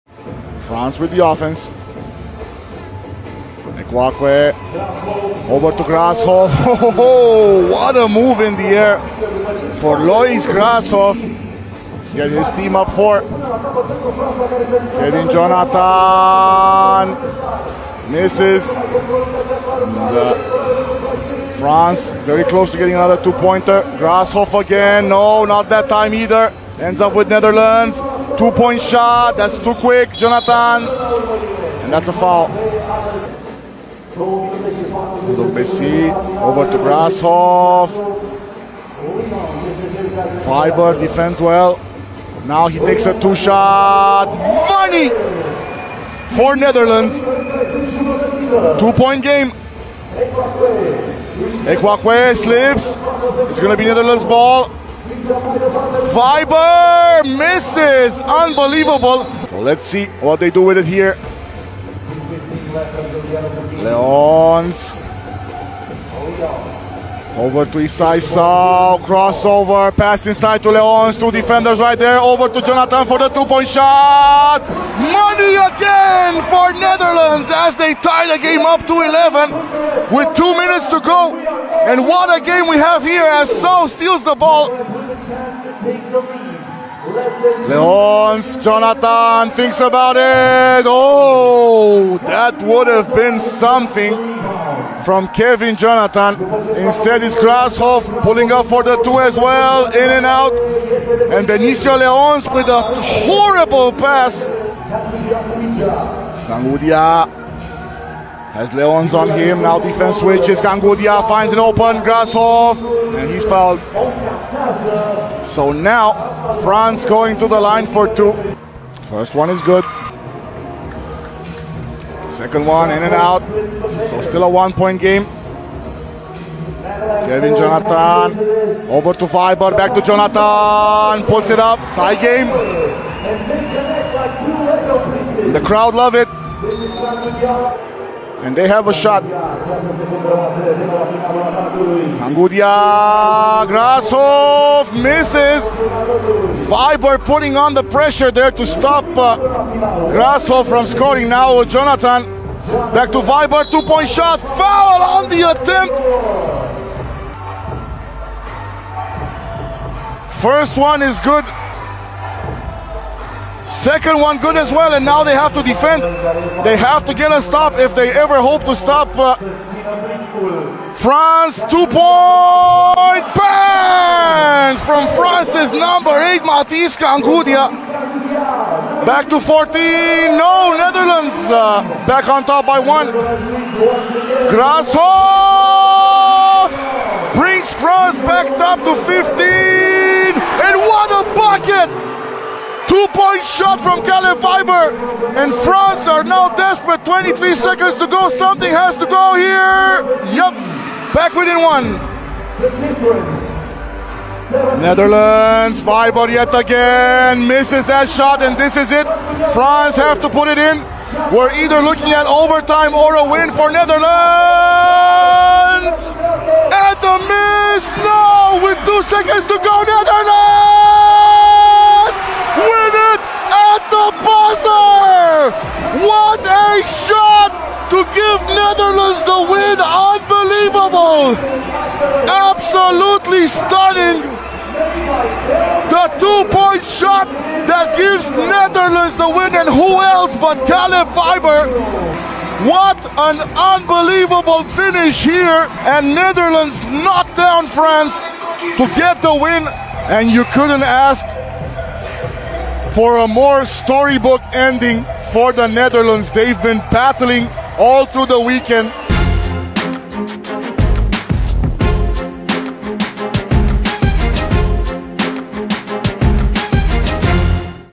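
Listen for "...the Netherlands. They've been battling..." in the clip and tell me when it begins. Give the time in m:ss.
4:15.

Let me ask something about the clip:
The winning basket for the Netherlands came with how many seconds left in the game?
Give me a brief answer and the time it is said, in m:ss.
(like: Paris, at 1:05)
2, at 3:38.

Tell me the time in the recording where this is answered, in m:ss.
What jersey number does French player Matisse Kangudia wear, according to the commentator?
2:55.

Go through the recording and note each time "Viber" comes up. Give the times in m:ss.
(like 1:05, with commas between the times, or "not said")
0:55, 2:09, 3:14, 3:25.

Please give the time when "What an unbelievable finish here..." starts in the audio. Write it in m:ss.
4:02.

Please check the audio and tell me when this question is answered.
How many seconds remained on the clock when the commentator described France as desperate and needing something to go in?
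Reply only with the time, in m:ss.
3:17.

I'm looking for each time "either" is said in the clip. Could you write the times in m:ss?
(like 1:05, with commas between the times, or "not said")
0:26, 3:31.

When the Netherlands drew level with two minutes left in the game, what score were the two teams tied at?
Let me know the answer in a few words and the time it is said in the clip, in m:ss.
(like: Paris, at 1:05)
11, at 1:19.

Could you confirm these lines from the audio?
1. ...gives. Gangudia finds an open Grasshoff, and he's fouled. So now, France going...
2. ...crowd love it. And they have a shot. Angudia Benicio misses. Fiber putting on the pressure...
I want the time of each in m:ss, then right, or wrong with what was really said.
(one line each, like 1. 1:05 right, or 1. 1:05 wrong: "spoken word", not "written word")
1. 1:50 wrong: "switches", not "gives"
2. 2:15 wrong: "Grashoff", not "Benicio".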